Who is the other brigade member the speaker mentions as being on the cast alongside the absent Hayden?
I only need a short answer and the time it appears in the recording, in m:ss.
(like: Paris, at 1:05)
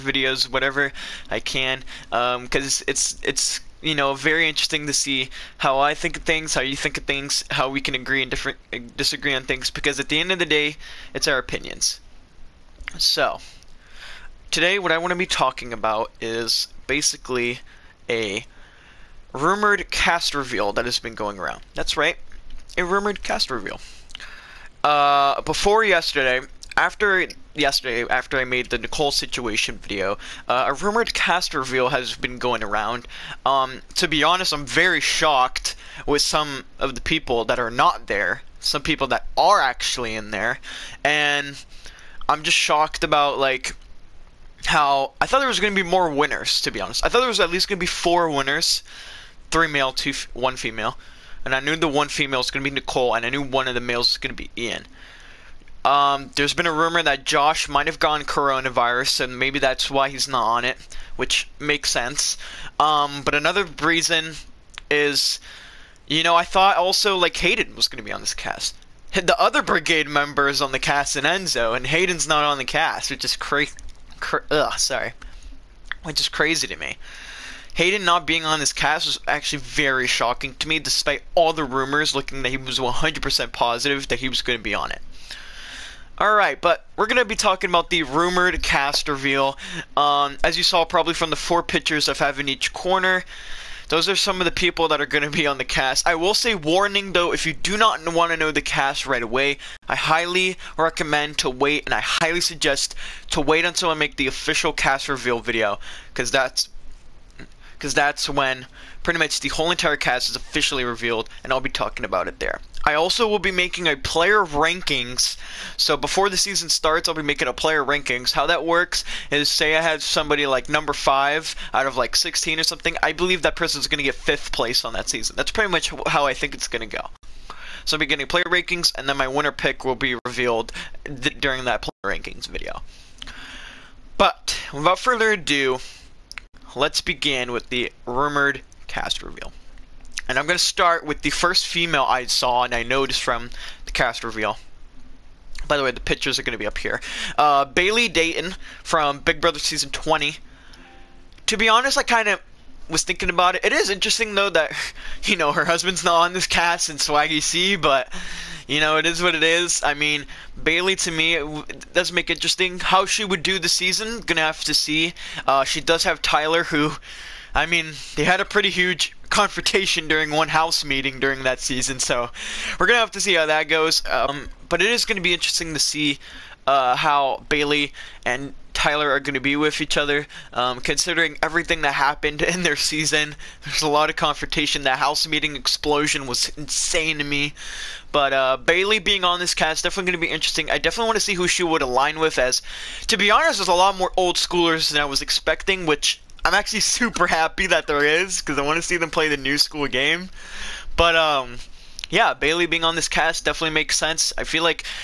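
Enzo, at 1:11.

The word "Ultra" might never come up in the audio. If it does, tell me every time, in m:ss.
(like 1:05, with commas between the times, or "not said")
not said.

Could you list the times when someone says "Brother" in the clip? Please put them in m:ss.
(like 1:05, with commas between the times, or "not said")
2:29.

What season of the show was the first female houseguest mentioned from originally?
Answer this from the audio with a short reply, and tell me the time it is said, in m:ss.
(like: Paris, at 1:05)
Season 20, at 2:29.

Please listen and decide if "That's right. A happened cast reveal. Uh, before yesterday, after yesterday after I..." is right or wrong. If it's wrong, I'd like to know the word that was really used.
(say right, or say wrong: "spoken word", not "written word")
wrong: "rumored", not "happened".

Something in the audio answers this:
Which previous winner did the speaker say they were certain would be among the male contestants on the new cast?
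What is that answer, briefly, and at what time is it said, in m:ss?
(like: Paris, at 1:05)
Ian, at 0:54.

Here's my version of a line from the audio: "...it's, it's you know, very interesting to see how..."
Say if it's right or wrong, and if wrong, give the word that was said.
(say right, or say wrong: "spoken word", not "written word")
right.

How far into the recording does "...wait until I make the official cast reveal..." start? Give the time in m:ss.
1:43.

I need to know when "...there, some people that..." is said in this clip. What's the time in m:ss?
0:38.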